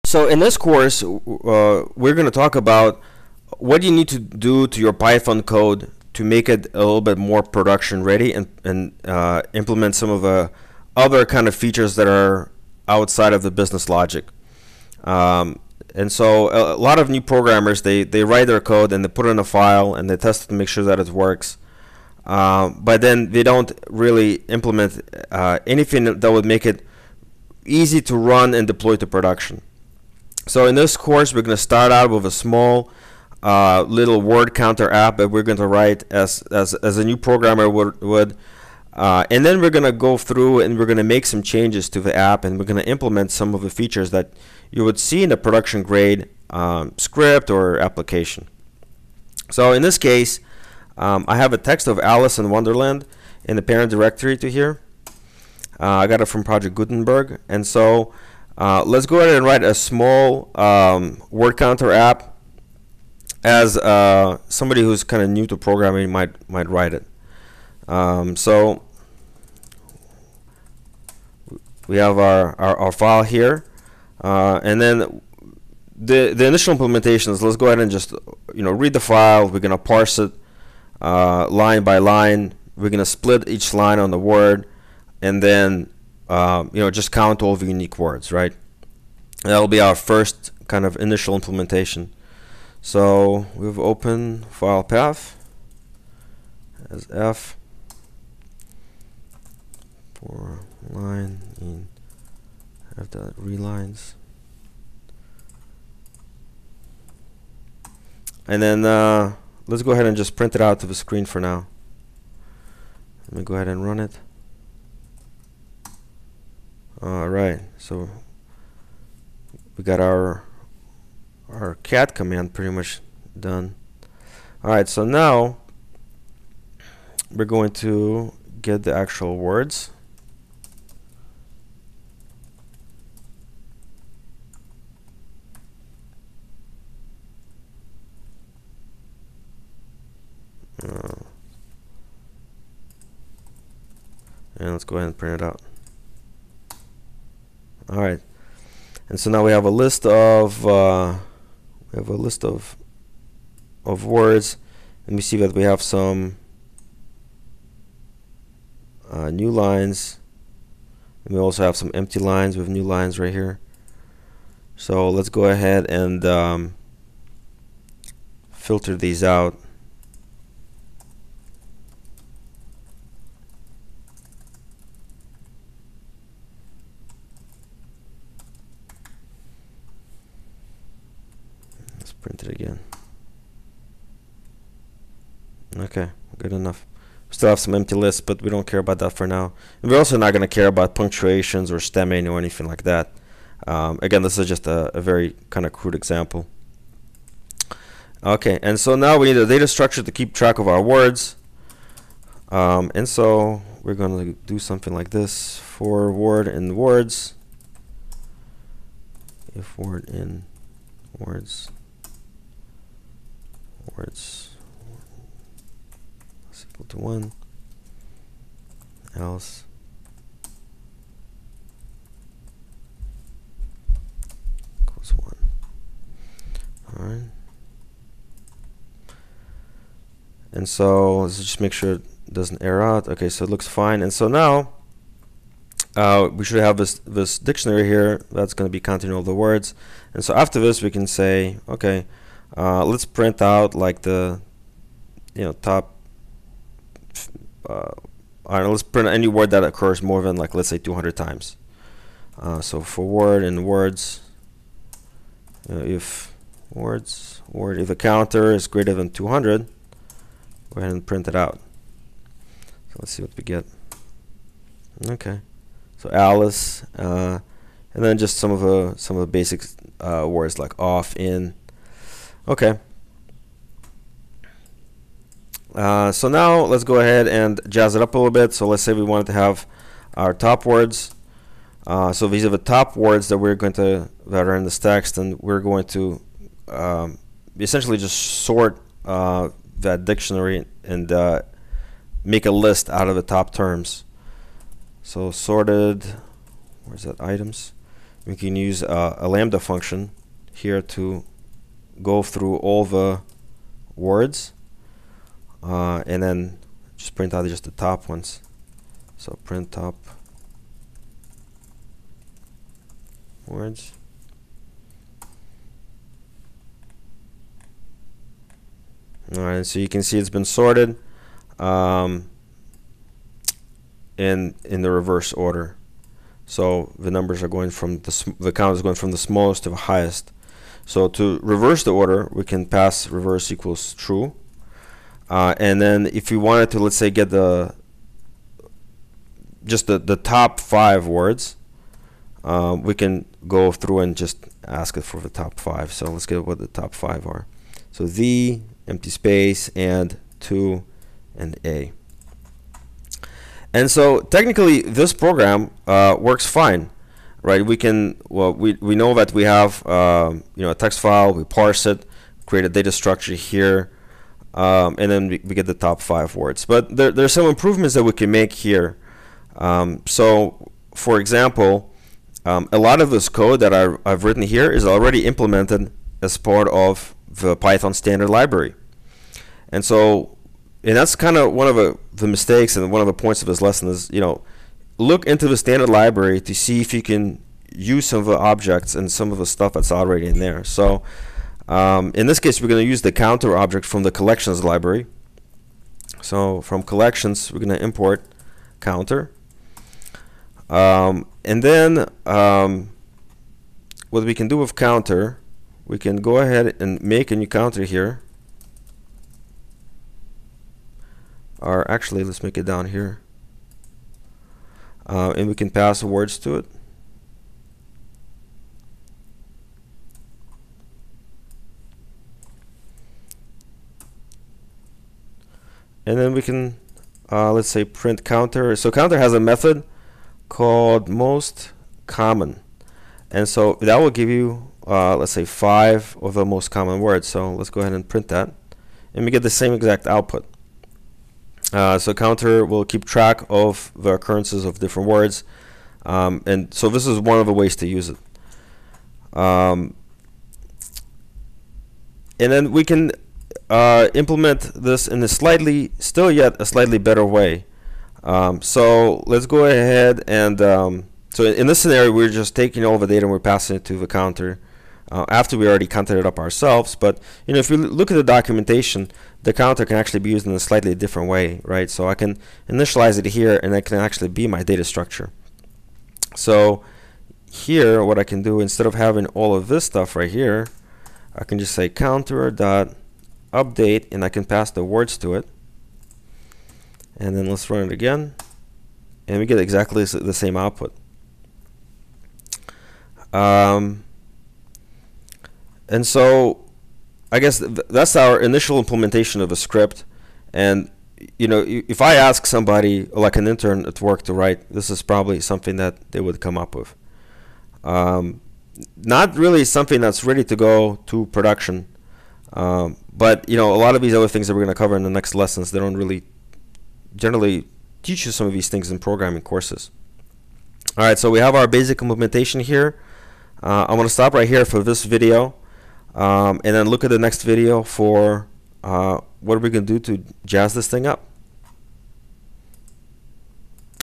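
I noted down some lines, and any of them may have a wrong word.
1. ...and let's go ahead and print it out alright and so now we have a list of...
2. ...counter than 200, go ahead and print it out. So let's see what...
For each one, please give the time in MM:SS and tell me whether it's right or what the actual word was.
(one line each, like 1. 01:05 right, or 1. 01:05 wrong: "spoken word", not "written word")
1. 02:24 right
2. 04:18 wrong: "greater", not "counter".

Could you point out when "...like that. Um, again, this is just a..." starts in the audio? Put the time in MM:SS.
03:12.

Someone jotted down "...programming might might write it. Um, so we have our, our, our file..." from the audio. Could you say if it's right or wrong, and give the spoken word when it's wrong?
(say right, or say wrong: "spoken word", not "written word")
right.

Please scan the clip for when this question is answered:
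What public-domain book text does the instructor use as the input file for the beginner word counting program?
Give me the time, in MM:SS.
00:51.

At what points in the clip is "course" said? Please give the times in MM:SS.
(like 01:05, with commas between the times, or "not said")
00:00, 00:30, 08:39.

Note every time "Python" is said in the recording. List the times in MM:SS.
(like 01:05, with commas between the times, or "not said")
00:04, 06:17.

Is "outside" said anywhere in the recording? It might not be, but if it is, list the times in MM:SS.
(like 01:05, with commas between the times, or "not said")
00:12.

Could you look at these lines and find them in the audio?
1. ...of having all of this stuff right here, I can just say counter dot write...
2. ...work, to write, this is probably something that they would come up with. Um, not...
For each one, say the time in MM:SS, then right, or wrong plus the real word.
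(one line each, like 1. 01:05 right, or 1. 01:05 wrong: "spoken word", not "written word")
1. 07:58 wrong: "update", not "write"
2. 08:24 right.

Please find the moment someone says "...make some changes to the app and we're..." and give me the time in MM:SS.
00:41.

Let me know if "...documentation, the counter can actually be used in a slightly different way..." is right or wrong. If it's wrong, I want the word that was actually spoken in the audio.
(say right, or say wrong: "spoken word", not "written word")
right.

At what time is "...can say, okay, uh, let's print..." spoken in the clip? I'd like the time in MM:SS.
04:00.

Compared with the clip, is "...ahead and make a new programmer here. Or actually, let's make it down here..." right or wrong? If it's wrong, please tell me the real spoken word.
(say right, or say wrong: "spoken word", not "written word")
wrong: "counter", not "programmer".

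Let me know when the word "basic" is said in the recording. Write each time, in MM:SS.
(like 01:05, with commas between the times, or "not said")
04:29, 08:41.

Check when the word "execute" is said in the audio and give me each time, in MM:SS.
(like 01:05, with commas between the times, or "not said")
not said.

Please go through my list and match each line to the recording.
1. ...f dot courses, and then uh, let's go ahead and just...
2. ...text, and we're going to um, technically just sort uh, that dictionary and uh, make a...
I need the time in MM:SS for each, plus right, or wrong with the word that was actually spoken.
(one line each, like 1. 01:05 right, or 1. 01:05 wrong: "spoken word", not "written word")
1. 01:42 wrong: "readlines", not "courses"
2. 04:44 wrong: "essentially", not "technically".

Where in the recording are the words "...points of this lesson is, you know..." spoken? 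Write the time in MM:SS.
06:23.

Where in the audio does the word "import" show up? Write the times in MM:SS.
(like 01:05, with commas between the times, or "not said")
06:37.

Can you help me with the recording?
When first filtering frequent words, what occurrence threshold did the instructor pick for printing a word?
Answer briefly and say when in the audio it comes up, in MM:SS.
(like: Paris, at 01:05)
200, at 04:10.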